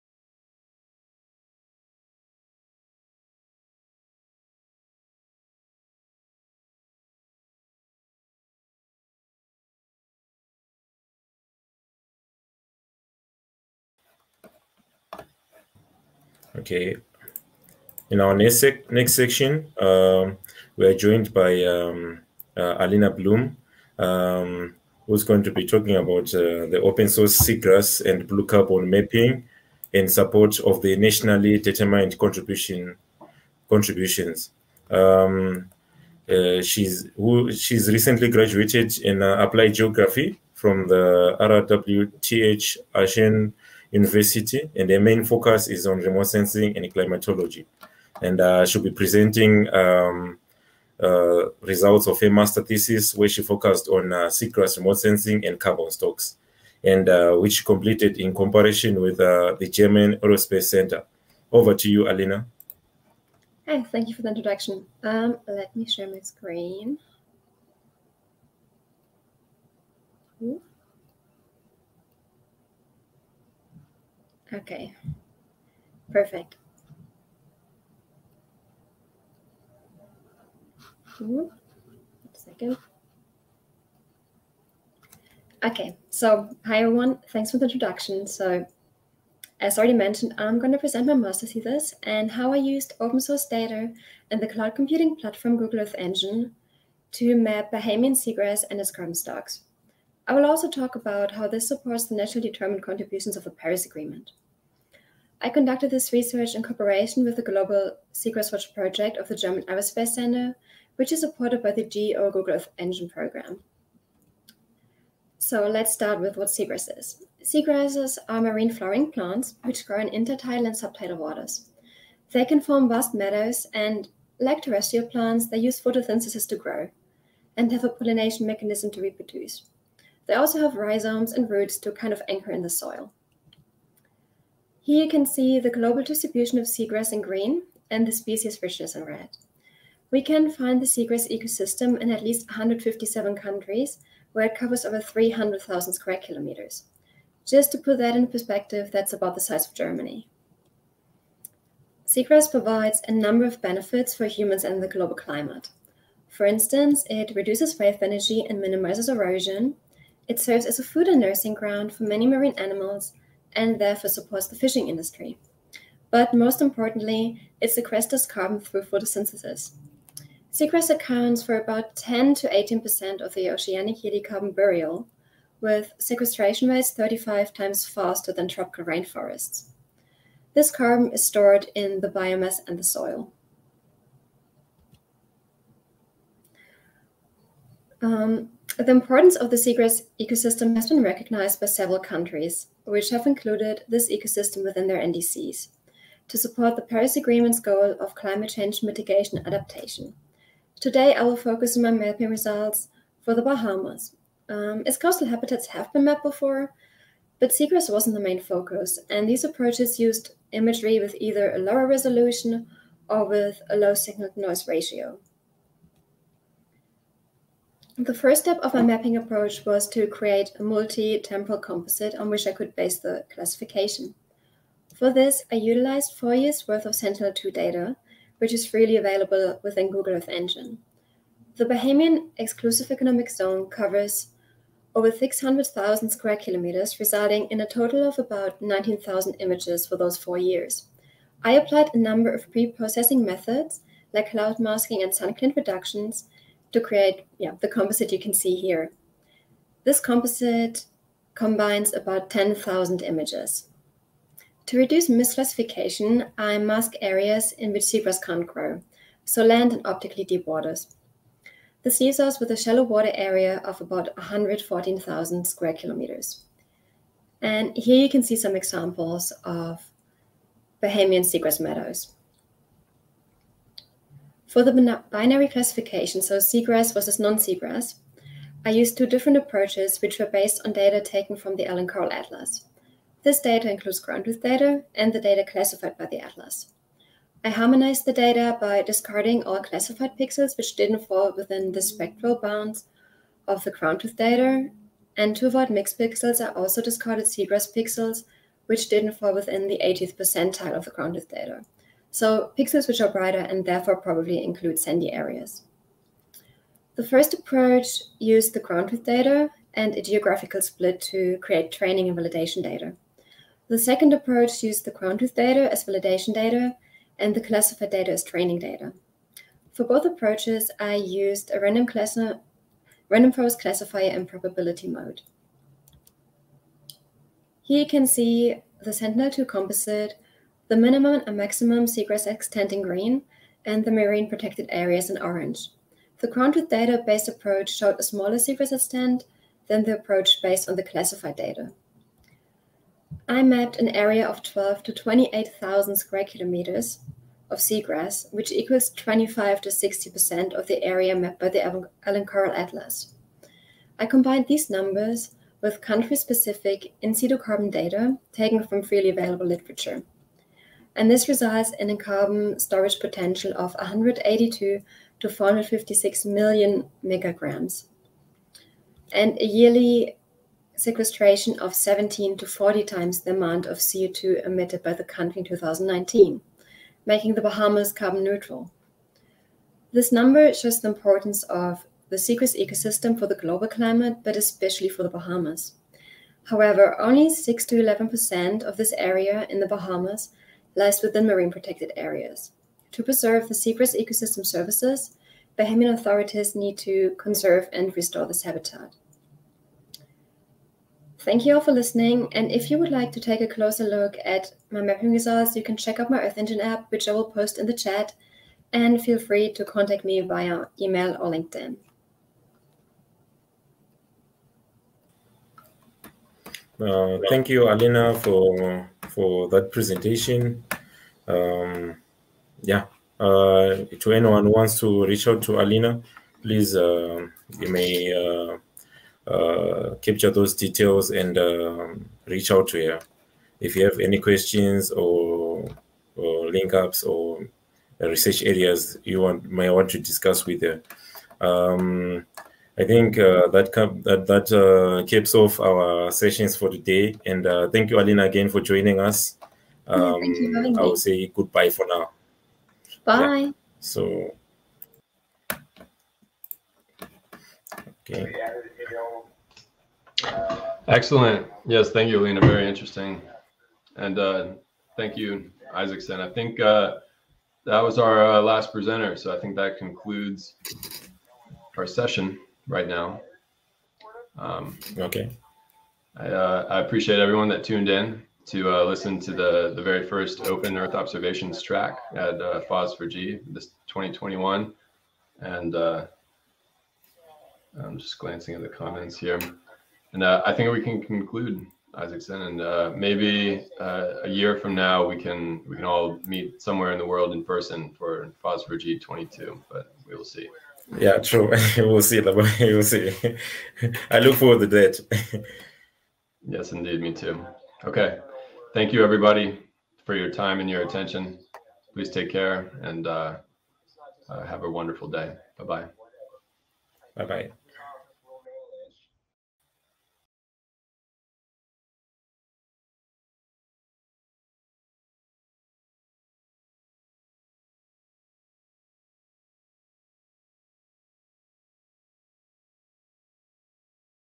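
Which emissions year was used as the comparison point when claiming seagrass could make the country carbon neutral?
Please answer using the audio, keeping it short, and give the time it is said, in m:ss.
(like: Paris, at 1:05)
2019, at 6:15.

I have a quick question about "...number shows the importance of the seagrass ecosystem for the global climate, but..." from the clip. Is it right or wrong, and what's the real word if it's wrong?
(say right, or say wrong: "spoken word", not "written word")
right.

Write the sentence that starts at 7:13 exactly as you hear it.
If you have any questions or, or link ups or research areas you want may want to discuss with her.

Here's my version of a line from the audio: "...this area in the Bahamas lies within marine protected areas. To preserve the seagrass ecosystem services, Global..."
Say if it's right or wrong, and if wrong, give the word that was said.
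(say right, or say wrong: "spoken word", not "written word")
wrong: "Bahamian", not "Global".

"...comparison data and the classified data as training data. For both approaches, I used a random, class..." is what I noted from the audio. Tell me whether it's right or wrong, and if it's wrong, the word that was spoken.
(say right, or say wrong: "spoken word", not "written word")
wrong: "validation", not "comparison".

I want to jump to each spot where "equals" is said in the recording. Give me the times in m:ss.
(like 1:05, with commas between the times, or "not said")
5:48.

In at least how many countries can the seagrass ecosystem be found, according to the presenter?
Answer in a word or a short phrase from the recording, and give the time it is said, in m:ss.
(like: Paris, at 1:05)
157, at 2:22.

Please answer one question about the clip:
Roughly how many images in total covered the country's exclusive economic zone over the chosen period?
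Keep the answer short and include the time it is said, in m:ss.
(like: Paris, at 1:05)
19,000, at 3:58.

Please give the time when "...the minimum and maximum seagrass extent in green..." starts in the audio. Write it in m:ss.
5:30.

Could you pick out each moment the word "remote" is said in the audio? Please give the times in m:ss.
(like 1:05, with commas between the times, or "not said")
0:45, 0:54.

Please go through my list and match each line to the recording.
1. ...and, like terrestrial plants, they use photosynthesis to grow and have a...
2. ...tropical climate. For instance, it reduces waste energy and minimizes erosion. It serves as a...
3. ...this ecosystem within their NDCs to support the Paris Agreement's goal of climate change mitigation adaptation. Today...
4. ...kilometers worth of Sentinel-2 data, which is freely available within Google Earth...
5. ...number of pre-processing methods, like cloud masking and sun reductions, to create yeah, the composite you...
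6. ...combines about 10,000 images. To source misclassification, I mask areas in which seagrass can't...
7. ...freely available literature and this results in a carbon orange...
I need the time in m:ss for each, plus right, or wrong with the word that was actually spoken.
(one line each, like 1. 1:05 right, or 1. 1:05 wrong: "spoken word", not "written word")
1. 2:03 right
2. 2:34 wrong: "global", not "tropical"
3. 3:13 right
4. 3:46 wrong: "years", not "kilometers"
5. 4:01 right
6. 4:11 wrong: "reduce", not "source"
7. 5:58 wrong: "storage", not "orange".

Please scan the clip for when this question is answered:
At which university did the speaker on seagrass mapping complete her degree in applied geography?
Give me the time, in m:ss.
0:41.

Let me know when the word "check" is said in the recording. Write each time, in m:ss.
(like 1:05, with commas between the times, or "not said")
6:45.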